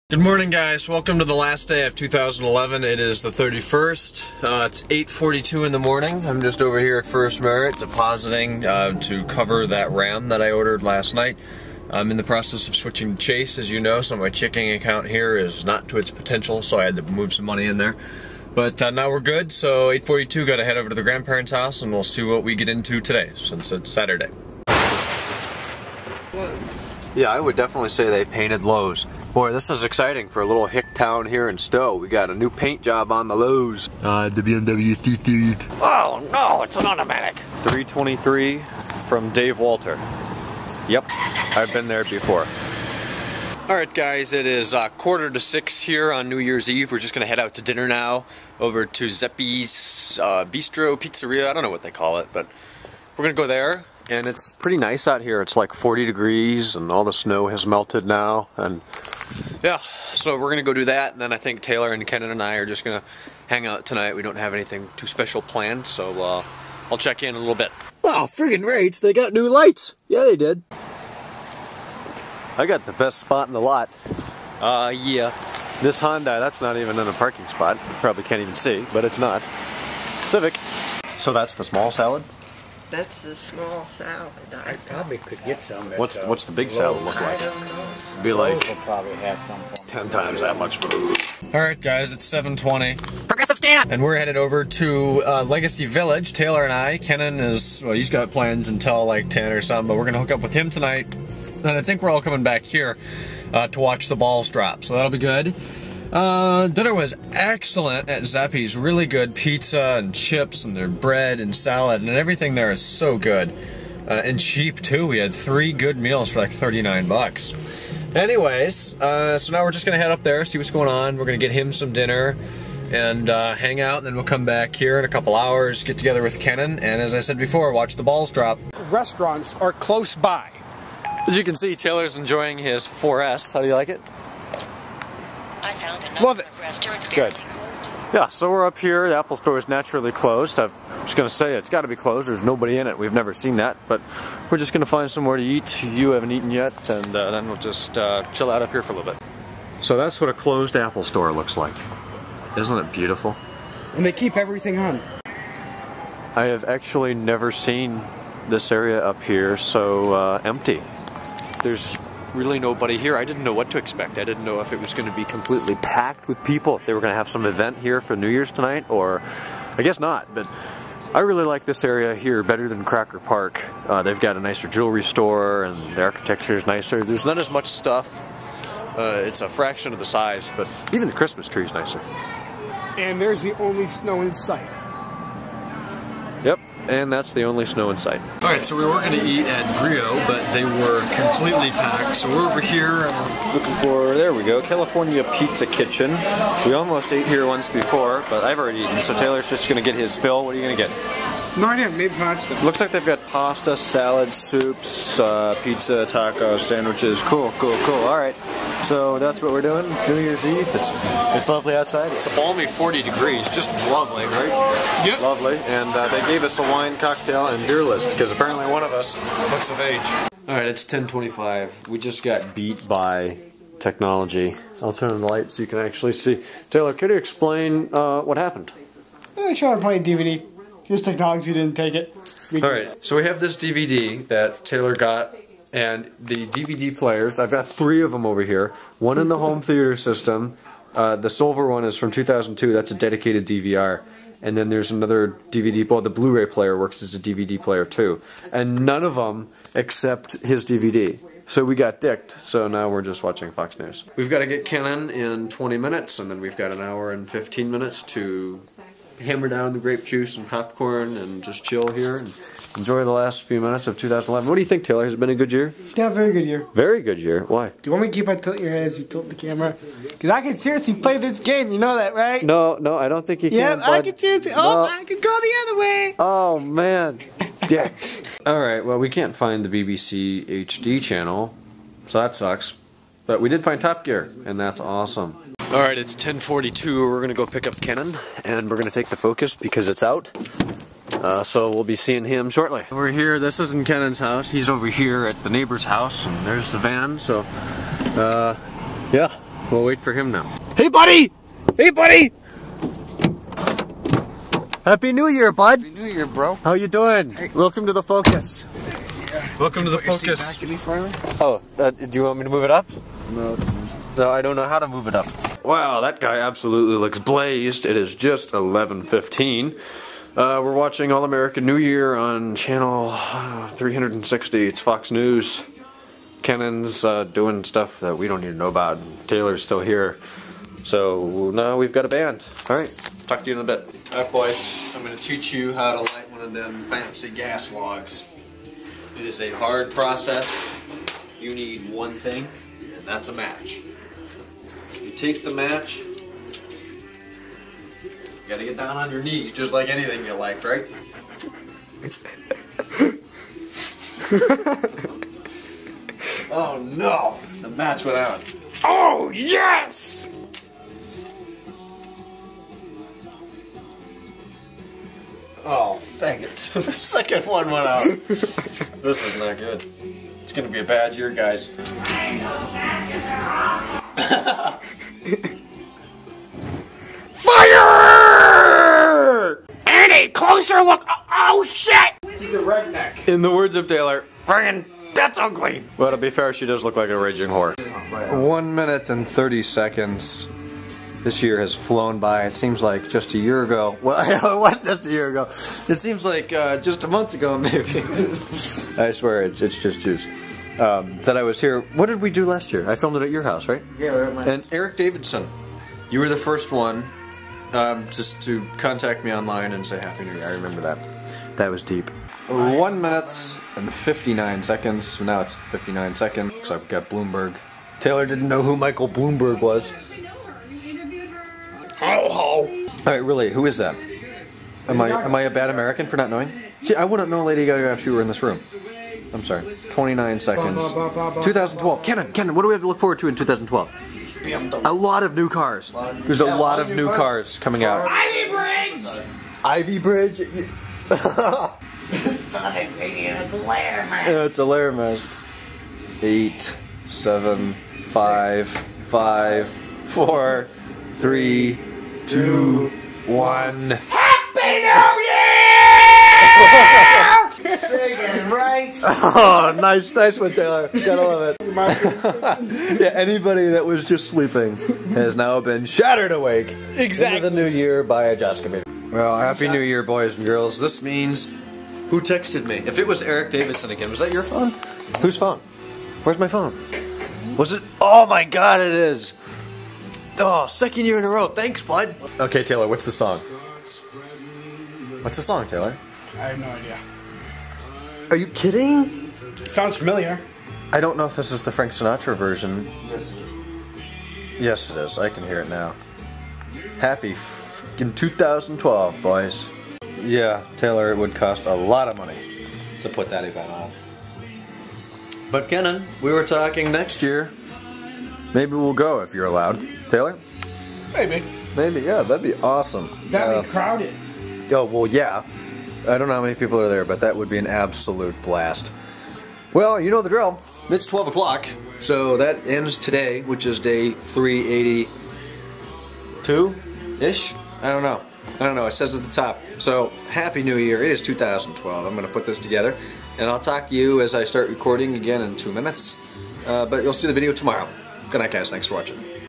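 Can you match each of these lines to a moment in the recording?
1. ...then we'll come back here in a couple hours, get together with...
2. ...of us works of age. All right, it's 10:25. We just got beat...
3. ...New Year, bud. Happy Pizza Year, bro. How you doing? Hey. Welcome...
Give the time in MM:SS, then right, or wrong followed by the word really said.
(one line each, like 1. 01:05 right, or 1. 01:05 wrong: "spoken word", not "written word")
1. 02:04 right
2. 03:38 wrong: "looks", not "works"
3. 05:05 wrong: "New", not "Pizza".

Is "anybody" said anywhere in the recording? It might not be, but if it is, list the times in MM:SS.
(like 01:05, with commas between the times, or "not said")
07:43.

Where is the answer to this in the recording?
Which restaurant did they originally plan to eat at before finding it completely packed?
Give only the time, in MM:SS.
03:09.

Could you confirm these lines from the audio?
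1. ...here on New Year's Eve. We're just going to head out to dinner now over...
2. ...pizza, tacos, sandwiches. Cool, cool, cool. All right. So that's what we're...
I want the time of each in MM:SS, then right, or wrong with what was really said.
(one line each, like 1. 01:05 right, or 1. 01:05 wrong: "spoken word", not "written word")
1. 00:45 right
2. 03:25 right.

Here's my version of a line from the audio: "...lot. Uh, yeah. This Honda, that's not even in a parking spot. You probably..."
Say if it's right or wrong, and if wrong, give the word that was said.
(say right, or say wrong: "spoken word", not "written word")
right.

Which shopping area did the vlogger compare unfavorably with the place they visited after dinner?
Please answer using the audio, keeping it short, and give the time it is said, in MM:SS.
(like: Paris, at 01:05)
Crocker Park, at 02:52.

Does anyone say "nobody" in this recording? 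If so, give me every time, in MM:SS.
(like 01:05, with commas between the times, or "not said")
02:22, 02:42.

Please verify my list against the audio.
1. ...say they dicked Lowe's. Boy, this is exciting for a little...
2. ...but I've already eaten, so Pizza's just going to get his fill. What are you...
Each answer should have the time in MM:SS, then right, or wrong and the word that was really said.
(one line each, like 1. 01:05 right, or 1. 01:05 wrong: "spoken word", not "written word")
1. 00:27 wrong: "painted", not "dicked"
2. 03:18 wrong: "Taylor", not "Pizza".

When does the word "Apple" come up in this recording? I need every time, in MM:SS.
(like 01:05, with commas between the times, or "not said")
02:19, 02:30.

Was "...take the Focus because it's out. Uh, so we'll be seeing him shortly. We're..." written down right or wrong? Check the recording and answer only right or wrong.
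right.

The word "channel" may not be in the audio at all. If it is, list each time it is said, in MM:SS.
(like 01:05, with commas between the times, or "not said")
04:41, 05:22.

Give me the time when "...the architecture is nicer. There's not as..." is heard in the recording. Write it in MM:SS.
02:55.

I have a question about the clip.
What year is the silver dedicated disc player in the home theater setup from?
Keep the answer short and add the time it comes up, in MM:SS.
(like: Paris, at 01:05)
2002, at 04:02.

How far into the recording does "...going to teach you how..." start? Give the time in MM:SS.
05:35.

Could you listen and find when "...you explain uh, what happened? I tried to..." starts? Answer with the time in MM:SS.
03:47.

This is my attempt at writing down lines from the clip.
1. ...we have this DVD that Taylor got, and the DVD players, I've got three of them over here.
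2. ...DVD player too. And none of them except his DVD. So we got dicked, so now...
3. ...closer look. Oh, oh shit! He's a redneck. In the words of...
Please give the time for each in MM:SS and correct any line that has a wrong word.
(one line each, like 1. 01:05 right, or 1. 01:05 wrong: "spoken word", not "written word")
1. 03:53 right
2. 04:07 right
3. 06:20 right.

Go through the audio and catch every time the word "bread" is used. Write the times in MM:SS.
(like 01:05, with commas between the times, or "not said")
01:50.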